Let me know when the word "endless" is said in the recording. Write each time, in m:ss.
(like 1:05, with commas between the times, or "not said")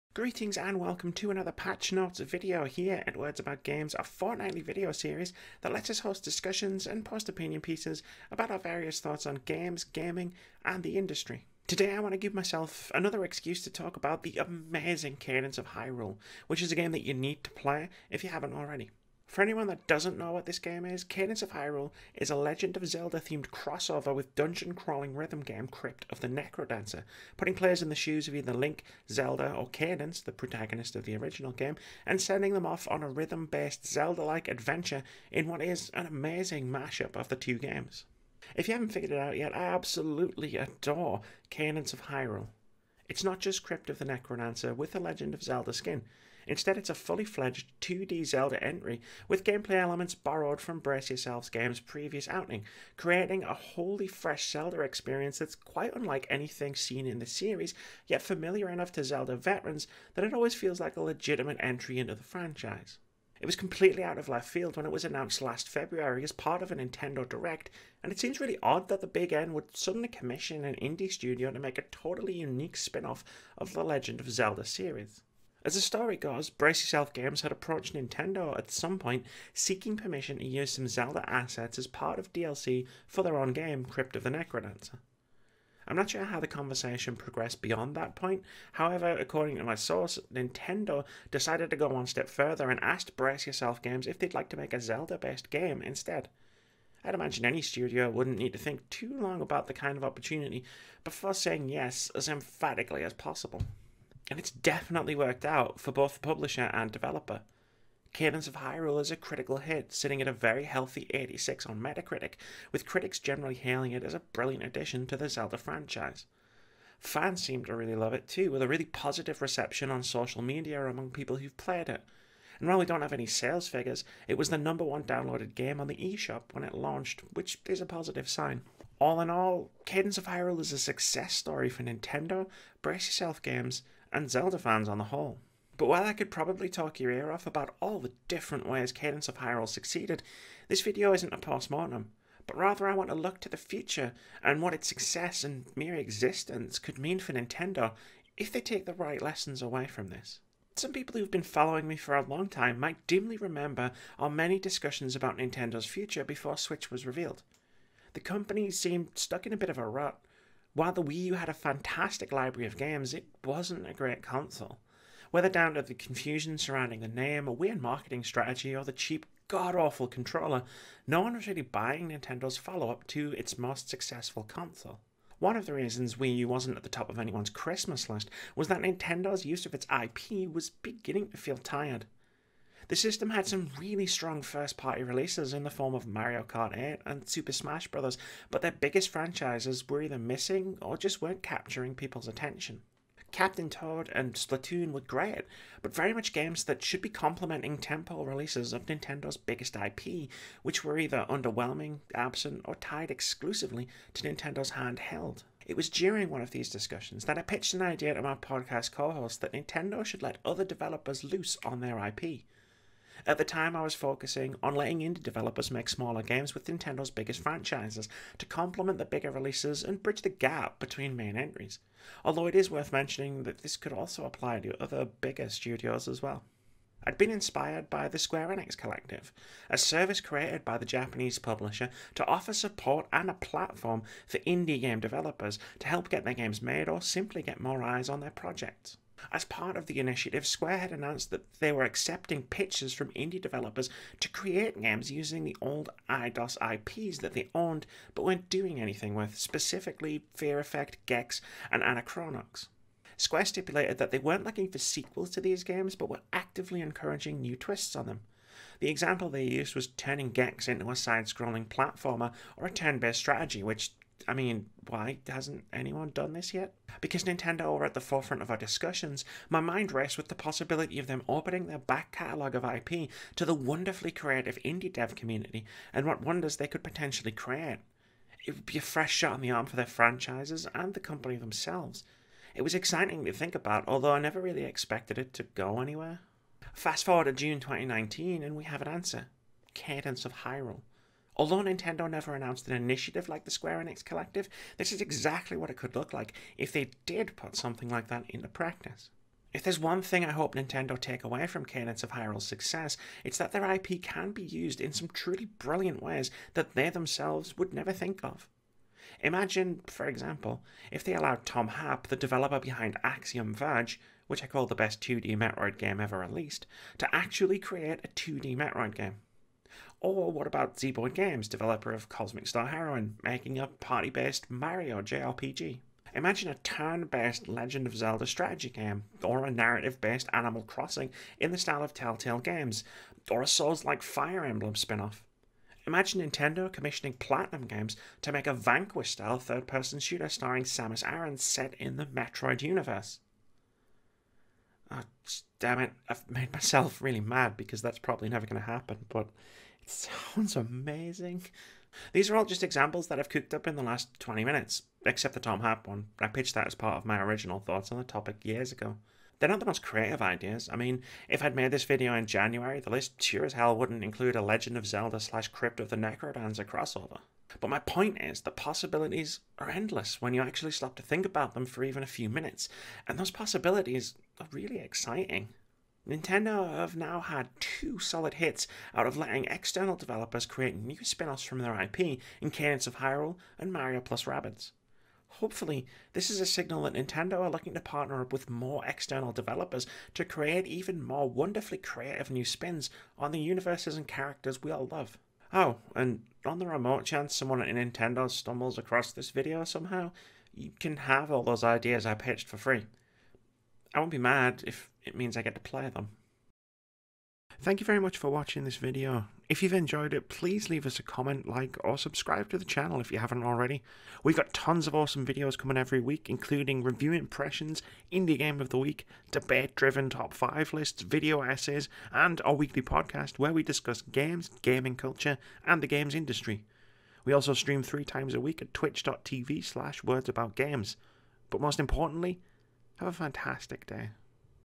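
6:09.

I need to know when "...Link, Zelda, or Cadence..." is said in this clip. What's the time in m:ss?
0:28.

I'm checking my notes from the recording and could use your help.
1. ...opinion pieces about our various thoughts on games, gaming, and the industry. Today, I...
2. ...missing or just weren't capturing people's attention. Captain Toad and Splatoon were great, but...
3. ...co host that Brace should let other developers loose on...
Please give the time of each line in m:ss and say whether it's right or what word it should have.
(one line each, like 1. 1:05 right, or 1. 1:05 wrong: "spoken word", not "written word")
1. 0:07 right
2. 3:10 right
3. 3:28 wrong: "Nintendo", not "Brace".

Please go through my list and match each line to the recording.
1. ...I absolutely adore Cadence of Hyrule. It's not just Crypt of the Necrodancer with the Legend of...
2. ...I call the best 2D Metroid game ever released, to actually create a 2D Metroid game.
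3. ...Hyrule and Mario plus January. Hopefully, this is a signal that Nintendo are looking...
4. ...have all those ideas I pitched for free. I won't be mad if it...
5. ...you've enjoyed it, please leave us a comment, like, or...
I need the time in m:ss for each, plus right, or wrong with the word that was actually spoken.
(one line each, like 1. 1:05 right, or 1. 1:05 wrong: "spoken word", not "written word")
1. 0:39 right
2. 5:14 right
3. 6:22 wrong: "Rabbids", not "January"
4. 6:40 right
5. 6:49 right.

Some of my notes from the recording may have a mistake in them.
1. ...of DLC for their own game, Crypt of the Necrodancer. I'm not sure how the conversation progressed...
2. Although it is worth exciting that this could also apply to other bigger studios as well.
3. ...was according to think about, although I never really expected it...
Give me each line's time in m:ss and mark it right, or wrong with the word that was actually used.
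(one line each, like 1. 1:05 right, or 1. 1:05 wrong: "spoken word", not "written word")
1. 1:22 right
2. 3:42 wrong: "mentioning", not "exciting"
3. 4:42 wrong: "exciting", not "according".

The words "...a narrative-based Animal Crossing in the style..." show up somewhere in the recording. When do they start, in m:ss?
5:29.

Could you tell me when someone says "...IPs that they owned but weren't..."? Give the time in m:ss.
4:06.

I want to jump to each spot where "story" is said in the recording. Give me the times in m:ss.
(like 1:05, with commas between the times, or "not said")
1:15, 2:11.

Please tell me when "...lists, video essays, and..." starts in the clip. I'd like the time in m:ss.
7:00.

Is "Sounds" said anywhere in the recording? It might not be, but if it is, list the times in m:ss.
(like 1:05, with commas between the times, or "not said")
5:49.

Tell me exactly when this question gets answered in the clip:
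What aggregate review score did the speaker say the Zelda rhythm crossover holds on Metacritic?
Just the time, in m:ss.
1:51.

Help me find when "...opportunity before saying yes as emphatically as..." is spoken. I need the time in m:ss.
1:40.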